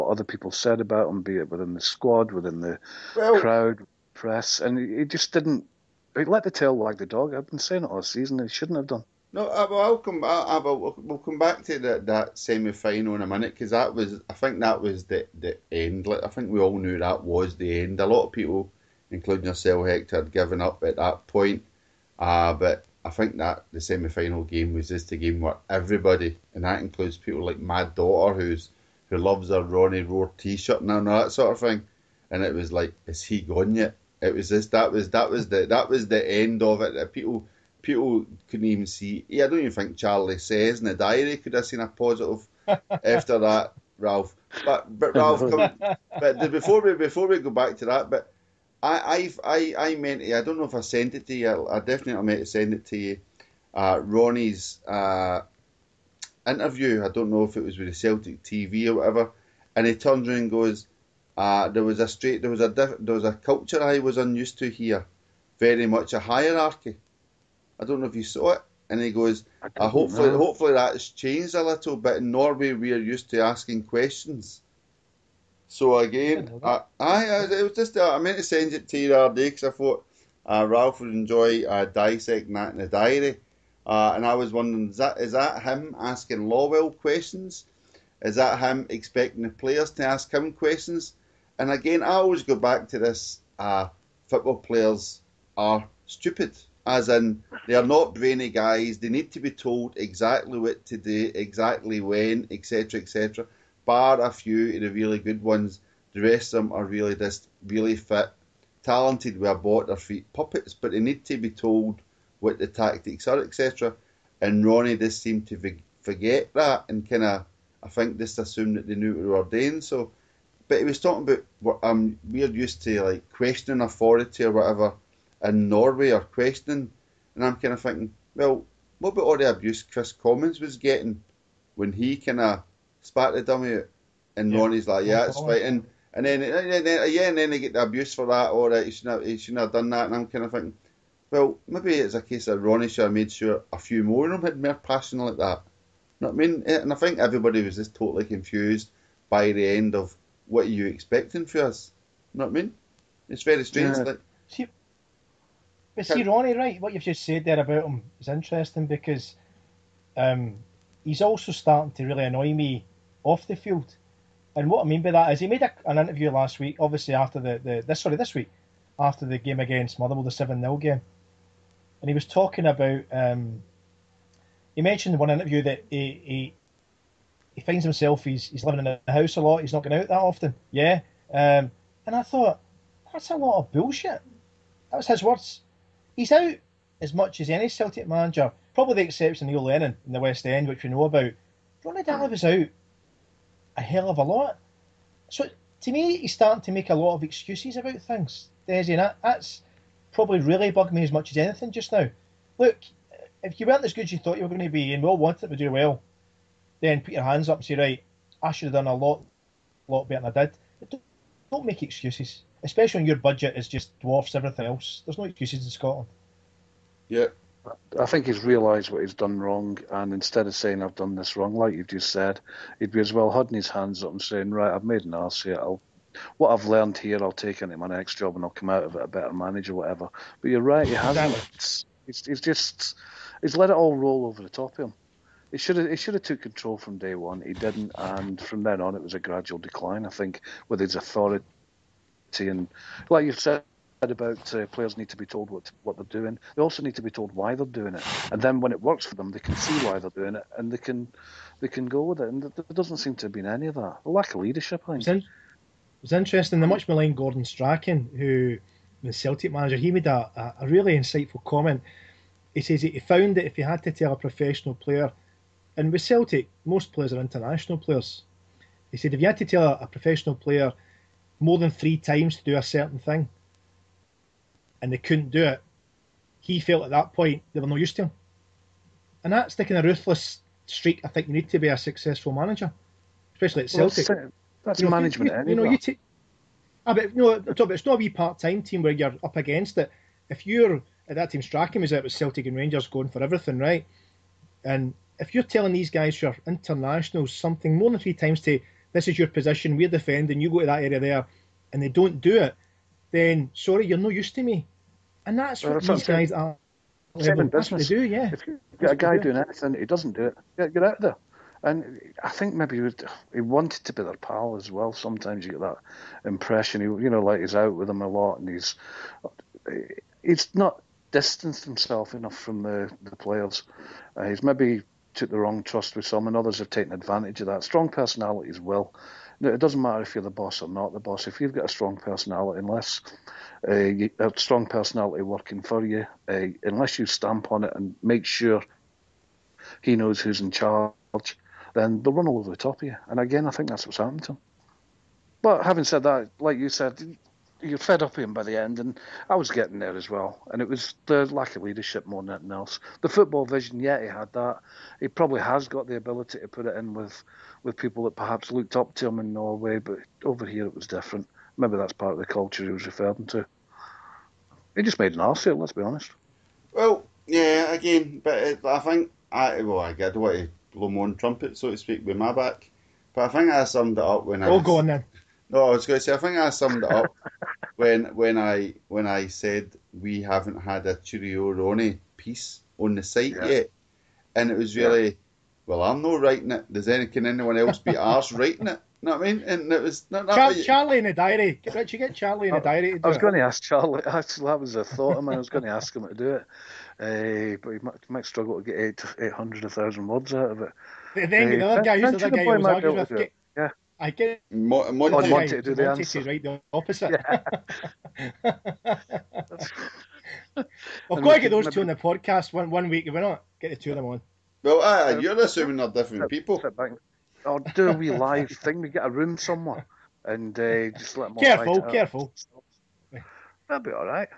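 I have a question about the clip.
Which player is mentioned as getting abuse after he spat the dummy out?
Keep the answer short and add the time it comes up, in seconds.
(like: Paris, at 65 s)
Kris Commons, at 129 s.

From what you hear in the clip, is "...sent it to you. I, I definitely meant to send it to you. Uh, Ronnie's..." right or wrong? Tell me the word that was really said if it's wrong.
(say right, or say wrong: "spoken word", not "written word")
right.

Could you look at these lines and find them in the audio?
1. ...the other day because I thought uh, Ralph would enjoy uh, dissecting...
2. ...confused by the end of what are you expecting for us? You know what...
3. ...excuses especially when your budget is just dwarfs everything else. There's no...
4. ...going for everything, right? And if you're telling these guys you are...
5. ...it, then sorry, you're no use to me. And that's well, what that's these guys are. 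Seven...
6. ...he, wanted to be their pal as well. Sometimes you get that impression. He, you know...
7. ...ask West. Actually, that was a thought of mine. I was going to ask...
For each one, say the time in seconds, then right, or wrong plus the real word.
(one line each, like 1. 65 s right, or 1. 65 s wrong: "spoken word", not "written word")
1. 79 s right
2. 148 s right
3. 211 s right
4. 292 s right
5. 302 s right
6. 313 s right
7. 393 s wrong: "Charlie", not "West".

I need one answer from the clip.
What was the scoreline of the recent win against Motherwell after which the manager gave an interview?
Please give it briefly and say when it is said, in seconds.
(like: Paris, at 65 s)
7-0, at 170 s.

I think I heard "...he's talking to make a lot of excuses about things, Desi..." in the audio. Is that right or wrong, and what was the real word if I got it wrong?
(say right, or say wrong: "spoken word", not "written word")
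wrong: "starting", not "talking".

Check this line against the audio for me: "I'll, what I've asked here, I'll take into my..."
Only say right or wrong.
wrong.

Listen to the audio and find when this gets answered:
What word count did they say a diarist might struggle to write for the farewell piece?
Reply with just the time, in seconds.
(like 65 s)
399 s.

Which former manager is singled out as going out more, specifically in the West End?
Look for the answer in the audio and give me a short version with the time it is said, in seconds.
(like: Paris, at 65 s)
Neil Lennon, at 189 s.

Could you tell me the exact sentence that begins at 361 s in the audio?
Maybe that's part of the culture he was referring to.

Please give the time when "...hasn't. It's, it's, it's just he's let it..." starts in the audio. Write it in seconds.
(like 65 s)
230 s.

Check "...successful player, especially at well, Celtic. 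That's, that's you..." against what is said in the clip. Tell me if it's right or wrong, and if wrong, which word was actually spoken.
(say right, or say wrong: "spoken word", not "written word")
wrong: "manager", not "player".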